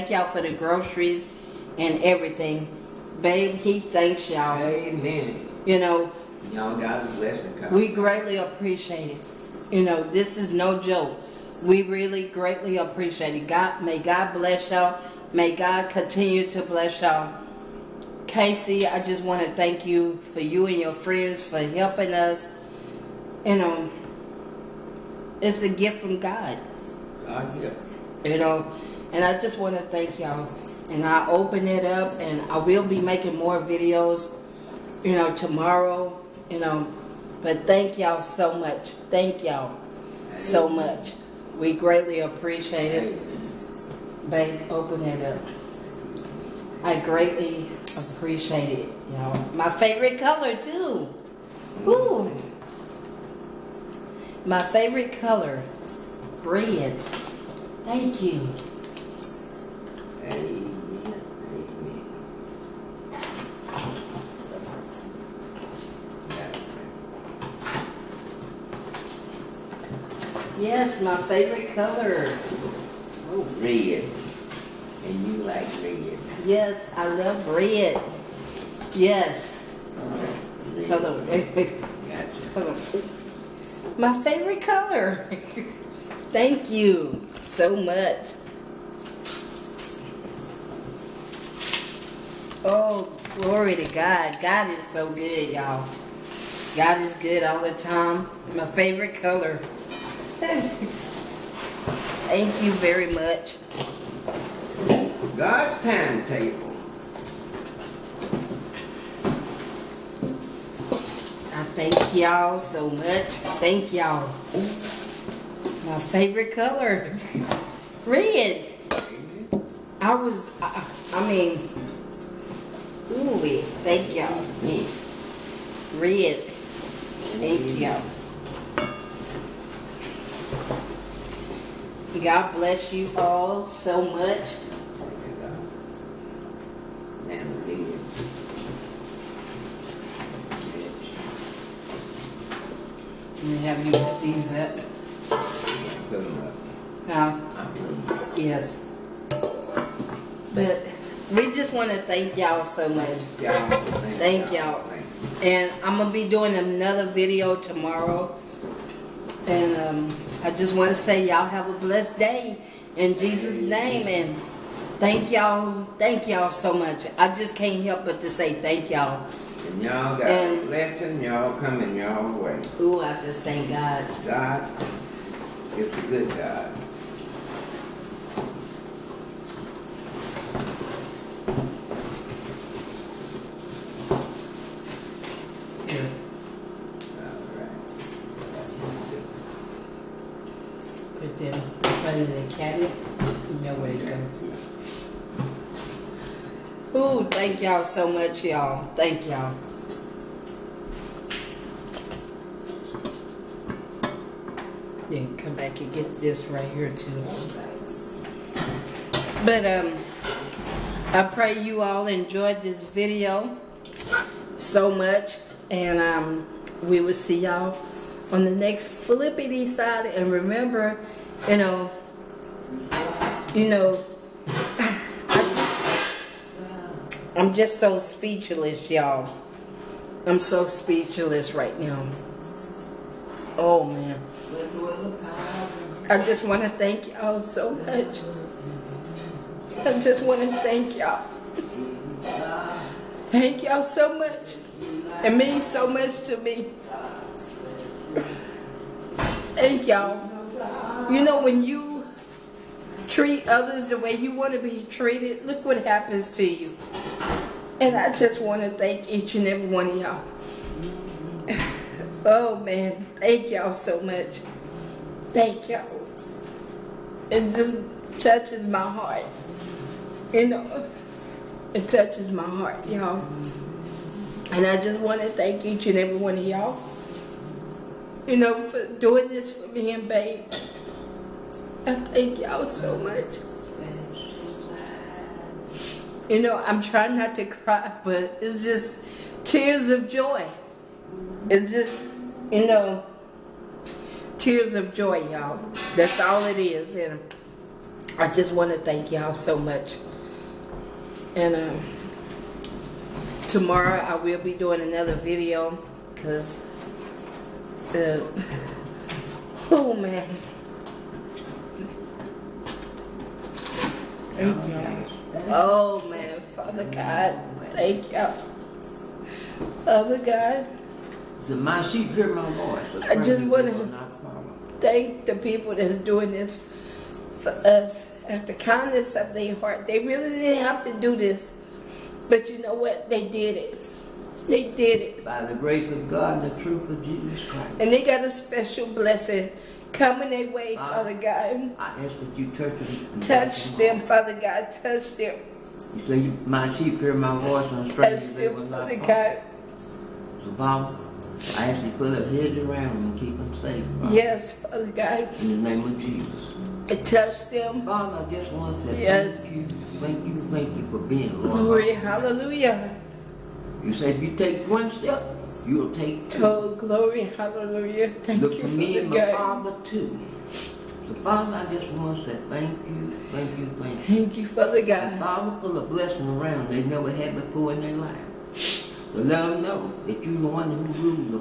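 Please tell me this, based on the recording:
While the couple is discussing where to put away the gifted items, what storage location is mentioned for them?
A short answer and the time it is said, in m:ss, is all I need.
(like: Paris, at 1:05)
The cabinet, at 3:12.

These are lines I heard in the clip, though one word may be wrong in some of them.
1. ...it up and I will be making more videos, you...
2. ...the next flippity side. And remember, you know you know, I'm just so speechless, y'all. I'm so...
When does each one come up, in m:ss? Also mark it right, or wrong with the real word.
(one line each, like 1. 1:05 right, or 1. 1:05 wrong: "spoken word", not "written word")
1. 0:31 right
2. 3:38 right.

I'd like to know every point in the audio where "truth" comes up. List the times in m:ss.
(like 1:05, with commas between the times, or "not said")
5:36.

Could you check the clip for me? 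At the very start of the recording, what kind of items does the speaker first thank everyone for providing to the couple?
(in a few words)
Groceries.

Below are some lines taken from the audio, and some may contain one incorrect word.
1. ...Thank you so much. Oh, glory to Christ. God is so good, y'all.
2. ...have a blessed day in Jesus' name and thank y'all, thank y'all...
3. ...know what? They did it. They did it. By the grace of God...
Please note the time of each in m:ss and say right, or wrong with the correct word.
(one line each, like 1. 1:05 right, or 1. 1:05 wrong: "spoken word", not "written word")
1. 1:26 wrong: "God", not "Christ"
2. 2:41 right
3. 5:32 right.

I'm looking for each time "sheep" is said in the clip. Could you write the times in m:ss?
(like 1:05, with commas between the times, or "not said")
5:21, 5:46.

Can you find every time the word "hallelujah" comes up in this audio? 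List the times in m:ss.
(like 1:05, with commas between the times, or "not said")
6:01, 6:07.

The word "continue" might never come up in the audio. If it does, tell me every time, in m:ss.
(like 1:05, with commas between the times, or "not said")
0:15.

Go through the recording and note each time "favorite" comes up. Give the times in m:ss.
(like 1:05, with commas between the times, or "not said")
0:49, 0:54, 1:11, 1:24, 1:38, 1:55.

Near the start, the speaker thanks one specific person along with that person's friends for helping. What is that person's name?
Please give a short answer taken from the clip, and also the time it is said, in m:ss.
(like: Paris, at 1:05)
Casey, at 0:18.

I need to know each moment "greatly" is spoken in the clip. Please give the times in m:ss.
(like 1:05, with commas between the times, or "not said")
0:07, 0:12, 0:41, 0:46.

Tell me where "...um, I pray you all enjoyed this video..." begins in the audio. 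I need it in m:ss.
3:29.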